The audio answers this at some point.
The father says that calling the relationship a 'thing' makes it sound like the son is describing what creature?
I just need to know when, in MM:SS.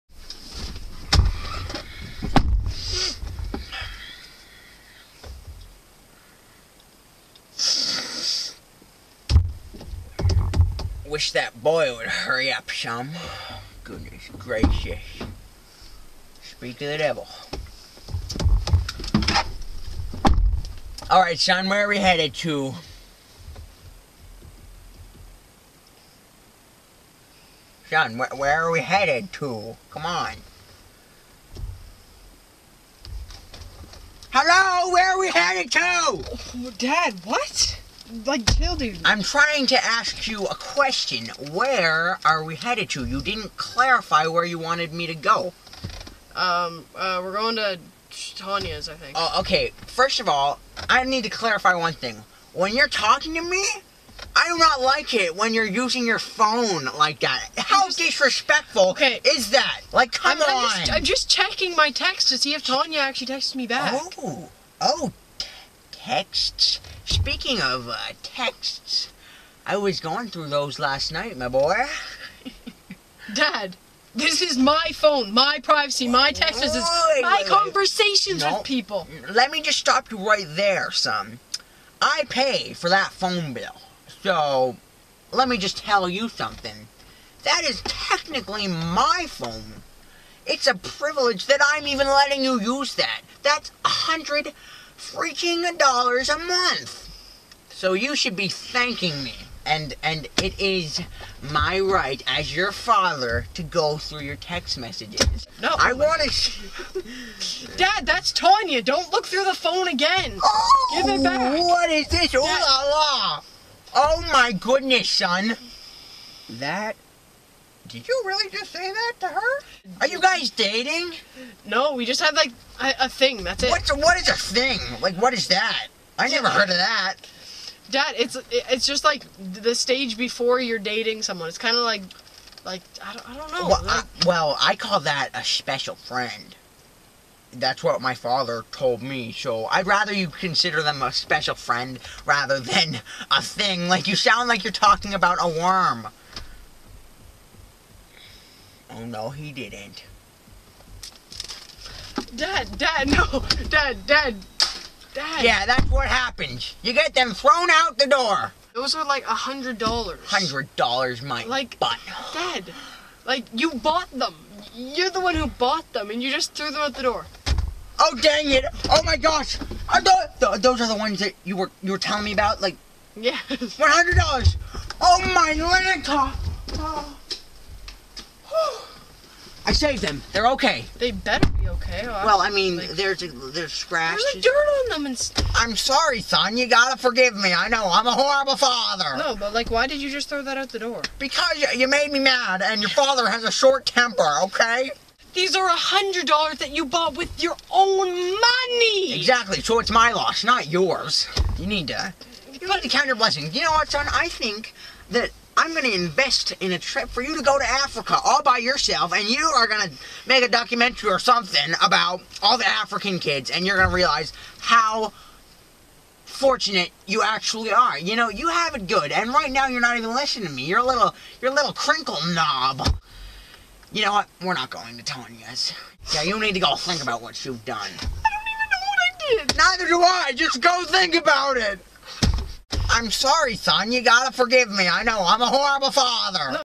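02:25.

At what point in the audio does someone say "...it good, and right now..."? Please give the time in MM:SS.
03:38.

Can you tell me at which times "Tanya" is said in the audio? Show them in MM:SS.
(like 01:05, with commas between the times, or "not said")
00:48, 01:02, 01:48.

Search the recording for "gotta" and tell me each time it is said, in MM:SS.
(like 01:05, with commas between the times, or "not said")
03:06, 03:54.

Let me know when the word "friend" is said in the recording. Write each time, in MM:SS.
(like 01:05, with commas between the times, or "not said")
02:15, 02:21.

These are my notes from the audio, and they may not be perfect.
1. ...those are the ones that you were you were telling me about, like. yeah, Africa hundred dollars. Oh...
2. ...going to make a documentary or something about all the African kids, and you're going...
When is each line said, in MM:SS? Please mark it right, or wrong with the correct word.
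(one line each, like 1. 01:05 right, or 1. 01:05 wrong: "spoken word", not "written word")
1. 02:50 wrong: "One", not "Africa"
2. 03:29 right.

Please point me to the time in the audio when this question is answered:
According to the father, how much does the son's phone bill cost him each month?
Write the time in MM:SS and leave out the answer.
01:33.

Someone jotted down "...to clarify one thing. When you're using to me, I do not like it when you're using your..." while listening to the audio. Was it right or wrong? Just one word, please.
wrong.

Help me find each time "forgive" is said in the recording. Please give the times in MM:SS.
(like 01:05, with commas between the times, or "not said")
03:06, 03:54.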